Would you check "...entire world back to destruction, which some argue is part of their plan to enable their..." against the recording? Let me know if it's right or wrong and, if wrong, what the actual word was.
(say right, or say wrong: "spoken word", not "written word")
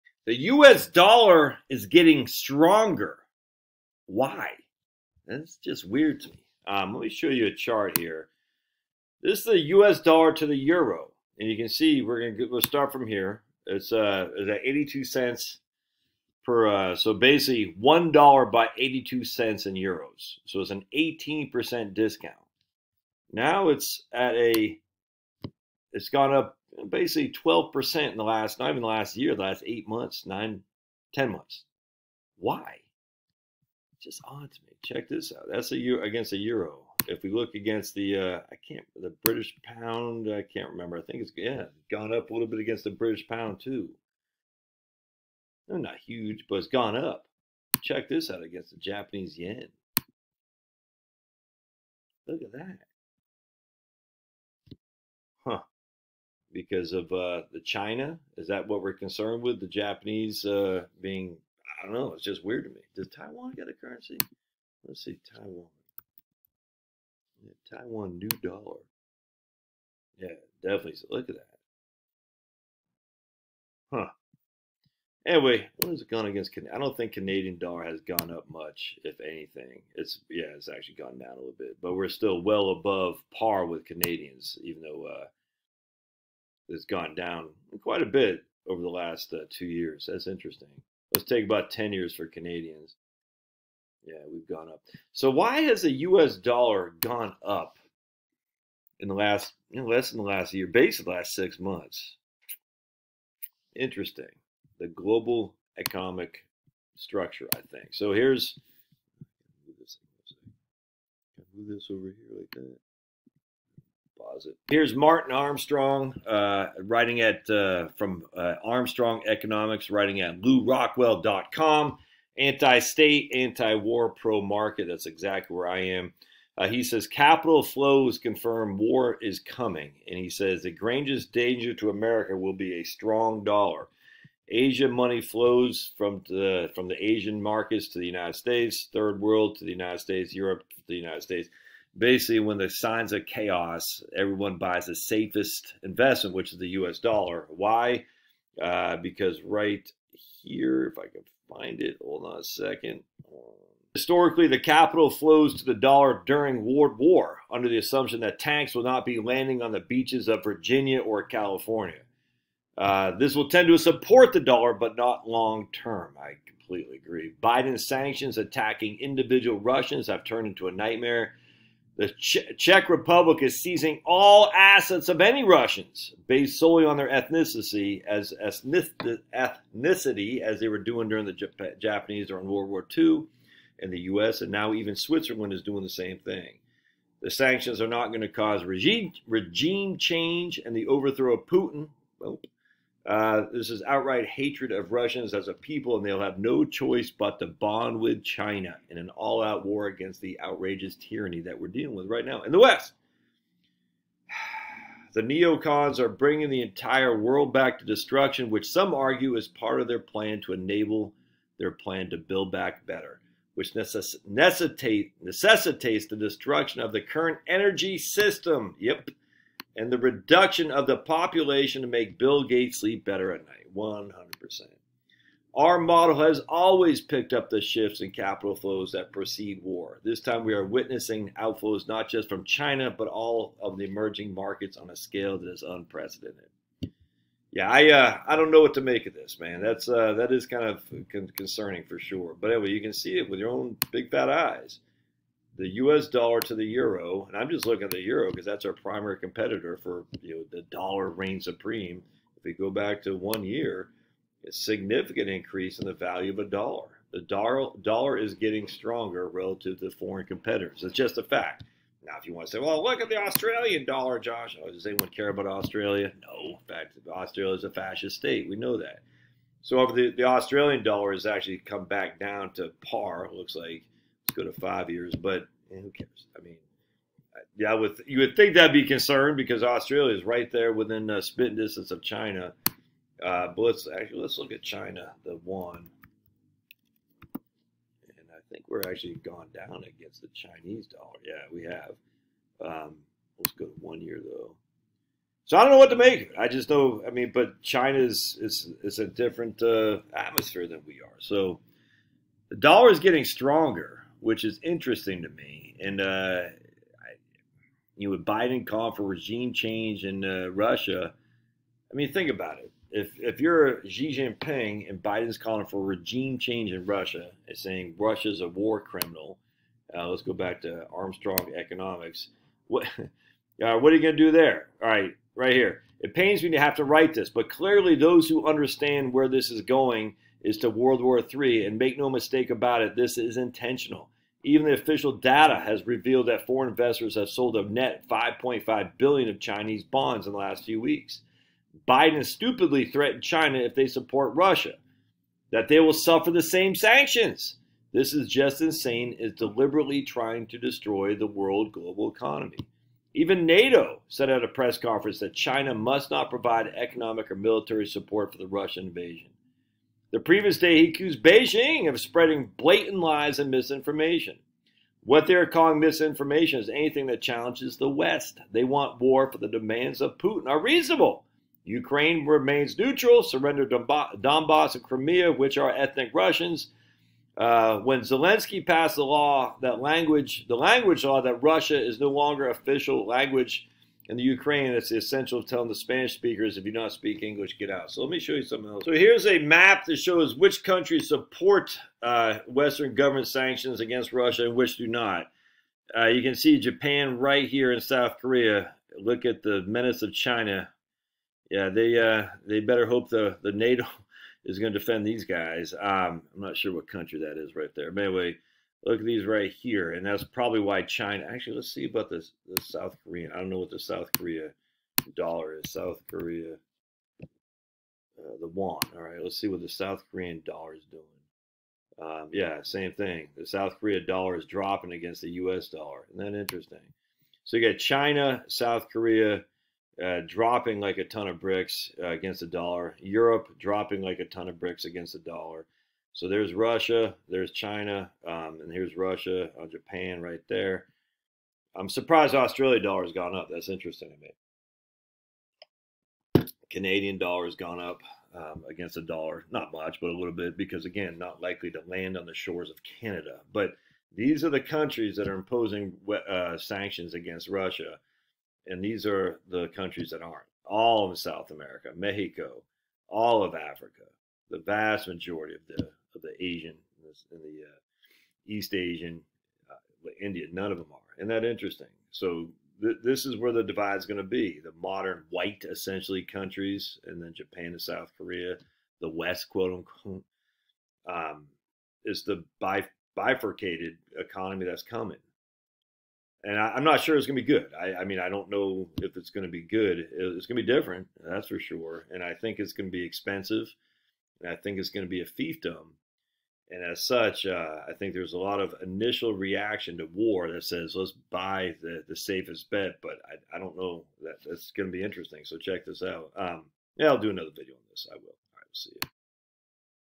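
right.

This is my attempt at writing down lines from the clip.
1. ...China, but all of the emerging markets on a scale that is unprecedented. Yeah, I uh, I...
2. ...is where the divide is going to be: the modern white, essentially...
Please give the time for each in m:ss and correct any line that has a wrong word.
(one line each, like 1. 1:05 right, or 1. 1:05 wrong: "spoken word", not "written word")
1. 3:52 right
2. 7:53 right.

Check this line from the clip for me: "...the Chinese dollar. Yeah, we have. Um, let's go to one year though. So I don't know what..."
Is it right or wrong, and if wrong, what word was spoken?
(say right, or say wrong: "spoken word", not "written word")
right.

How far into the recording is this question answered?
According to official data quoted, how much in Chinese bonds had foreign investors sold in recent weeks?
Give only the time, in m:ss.
5:38.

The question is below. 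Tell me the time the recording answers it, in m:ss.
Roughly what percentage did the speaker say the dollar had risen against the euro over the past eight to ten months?
0:27.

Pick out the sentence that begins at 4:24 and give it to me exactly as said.
Oh, does anyone care about Australia?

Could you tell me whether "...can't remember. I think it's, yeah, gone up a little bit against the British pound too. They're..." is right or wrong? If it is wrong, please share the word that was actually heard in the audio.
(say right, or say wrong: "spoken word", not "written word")
right.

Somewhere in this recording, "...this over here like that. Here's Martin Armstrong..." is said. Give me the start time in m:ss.
1:51.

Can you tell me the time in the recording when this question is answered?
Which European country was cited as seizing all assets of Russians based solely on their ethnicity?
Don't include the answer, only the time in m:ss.
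2:52.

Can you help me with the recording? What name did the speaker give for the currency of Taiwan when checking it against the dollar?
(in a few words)
Taiwan new dollar.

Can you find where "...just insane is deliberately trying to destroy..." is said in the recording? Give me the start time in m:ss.
5:48.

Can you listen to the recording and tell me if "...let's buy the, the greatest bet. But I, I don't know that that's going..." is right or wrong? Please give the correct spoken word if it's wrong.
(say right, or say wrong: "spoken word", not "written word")
wrong: "safest", not "greatest".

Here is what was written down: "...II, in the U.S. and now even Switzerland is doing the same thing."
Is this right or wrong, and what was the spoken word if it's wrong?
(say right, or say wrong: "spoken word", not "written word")
right.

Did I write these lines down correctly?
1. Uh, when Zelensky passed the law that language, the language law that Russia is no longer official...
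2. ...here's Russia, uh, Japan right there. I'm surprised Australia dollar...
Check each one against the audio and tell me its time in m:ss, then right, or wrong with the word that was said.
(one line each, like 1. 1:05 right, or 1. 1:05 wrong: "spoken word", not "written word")
1. 6:17 right
2. 7:18 right.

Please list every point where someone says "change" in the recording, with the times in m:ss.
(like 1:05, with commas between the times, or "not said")
3:09, 5:09, 5:16.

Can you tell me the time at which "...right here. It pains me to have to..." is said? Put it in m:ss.
5:25.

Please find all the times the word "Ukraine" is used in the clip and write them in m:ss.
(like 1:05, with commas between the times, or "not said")
6:11, 6:24.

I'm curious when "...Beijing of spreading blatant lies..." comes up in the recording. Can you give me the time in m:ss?
6:01.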